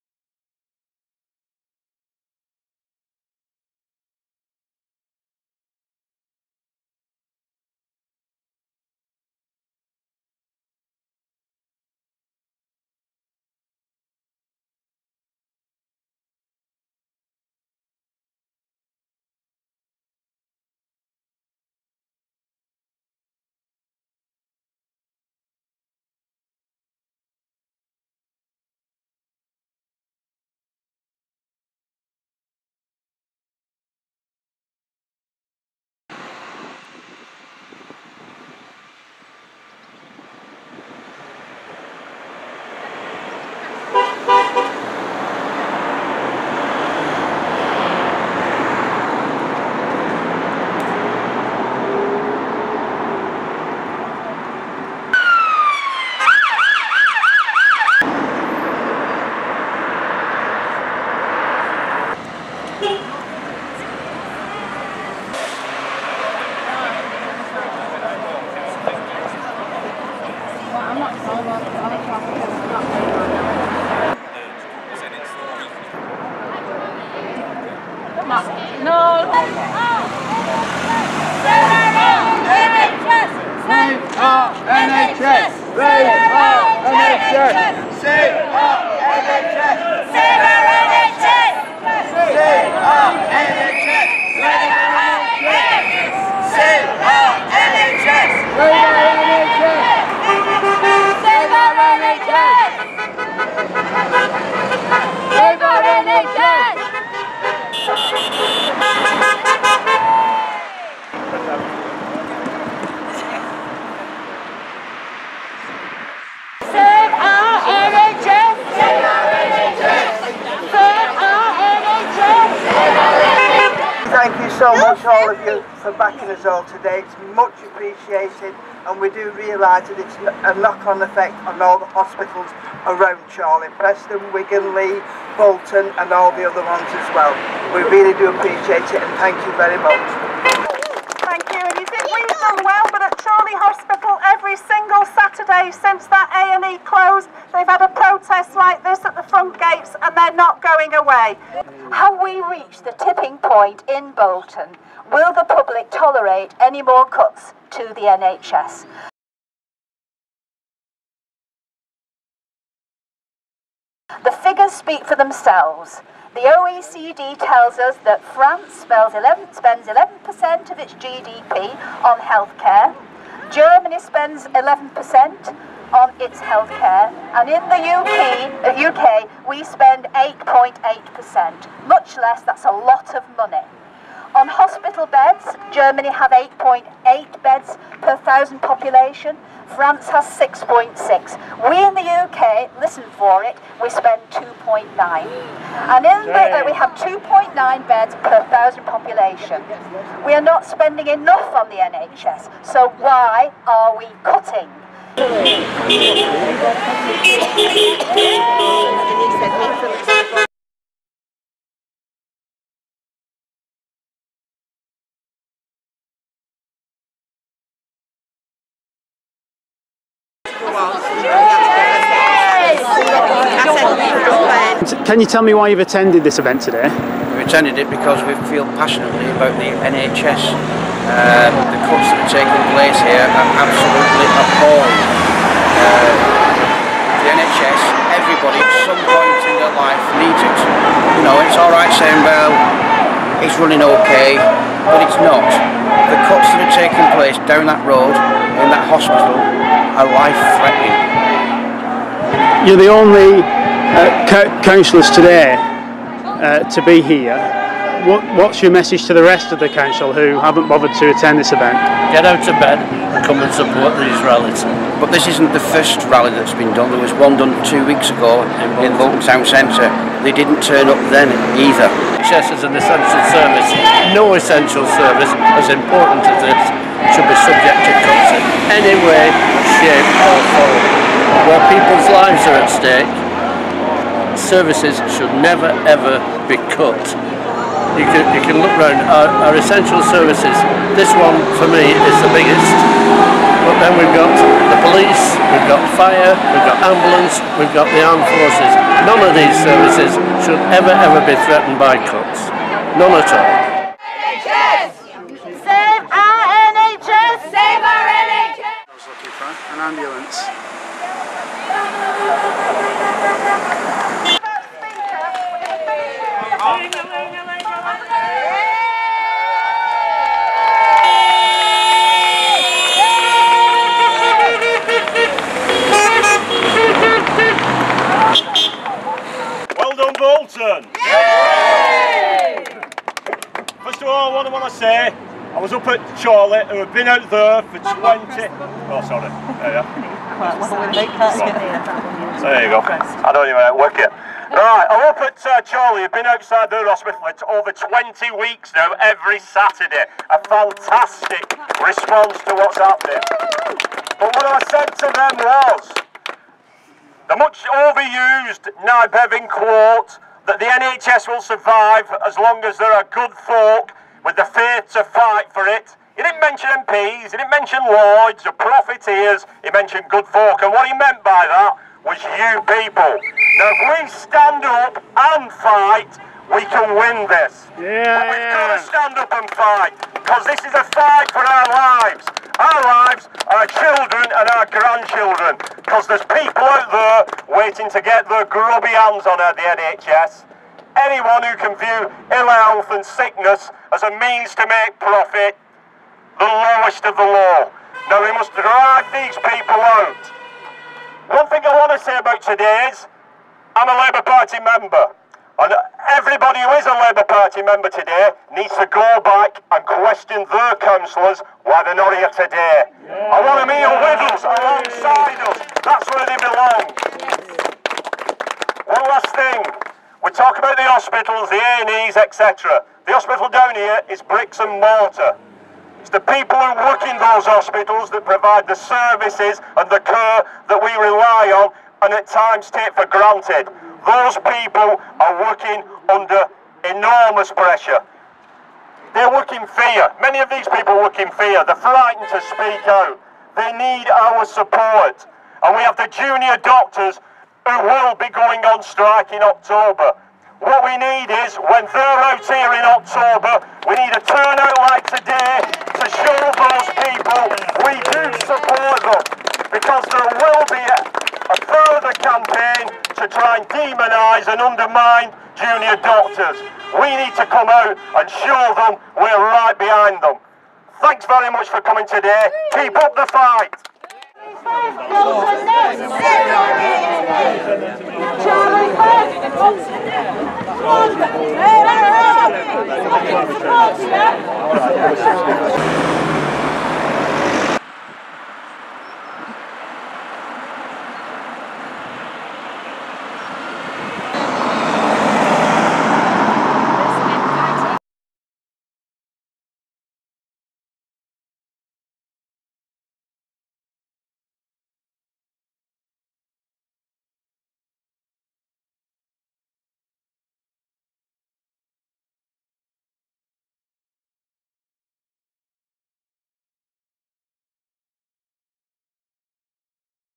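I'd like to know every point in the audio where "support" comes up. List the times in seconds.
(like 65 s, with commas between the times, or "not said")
263 s, 444 s, 458 s.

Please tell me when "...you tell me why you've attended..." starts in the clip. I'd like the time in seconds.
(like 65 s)
225 s.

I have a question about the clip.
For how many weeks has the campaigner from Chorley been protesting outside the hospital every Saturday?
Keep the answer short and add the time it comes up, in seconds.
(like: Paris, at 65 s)
Over 20 weeks, at 347 s.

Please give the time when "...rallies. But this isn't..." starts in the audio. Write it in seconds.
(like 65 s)
264 s.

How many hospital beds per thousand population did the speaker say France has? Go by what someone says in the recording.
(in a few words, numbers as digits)
6.6.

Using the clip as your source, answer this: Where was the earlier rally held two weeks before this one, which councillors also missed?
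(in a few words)
Bolton Town Centre.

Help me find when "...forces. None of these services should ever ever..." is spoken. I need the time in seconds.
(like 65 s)
298 s.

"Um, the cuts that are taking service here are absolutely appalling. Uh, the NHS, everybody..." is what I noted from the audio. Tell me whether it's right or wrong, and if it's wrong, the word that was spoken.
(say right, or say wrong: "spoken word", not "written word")
wrong: "place", not "service".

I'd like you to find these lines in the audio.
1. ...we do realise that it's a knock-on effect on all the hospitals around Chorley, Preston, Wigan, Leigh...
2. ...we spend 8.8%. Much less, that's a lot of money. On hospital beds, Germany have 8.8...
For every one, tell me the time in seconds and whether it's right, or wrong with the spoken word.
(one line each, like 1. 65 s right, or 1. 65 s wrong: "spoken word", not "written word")
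1. 129 s right
2. 179 s right.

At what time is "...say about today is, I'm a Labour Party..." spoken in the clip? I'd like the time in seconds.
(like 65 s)
402 s.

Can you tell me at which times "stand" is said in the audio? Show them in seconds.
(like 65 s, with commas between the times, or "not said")
374 s, 378 s.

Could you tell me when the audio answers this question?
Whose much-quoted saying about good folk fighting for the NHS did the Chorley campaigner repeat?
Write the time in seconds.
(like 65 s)
358 s.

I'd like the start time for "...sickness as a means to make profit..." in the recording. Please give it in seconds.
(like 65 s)
393 s.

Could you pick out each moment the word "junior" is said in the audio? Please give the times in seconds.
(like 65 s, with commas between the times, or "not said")
446 s, 465 s.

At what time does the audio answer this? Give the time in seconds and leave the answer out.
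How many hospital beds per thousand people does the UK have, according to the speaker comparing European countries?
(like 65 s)
196 s.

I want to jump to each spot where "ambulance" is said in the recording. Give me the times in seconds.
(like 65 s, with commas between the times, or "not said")
296 s, 309 s.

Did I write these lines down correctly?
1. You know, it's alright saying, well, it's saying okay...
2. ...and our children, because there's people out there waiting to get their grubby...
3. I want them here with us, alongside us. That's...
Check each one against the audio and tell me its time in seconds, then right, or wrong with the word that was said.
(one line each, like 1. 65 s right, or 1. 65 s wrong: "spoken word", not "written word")
1. 241 s wrong: "running", not "saying"
2. 384 s wrong: "grandchildren", not "children"
3. 413 s right.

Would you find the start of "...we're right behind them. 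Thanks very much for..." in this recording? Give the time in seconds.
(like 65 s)
469 s.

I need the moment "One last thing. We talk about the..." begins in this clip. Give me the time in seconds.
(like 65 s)
418 s.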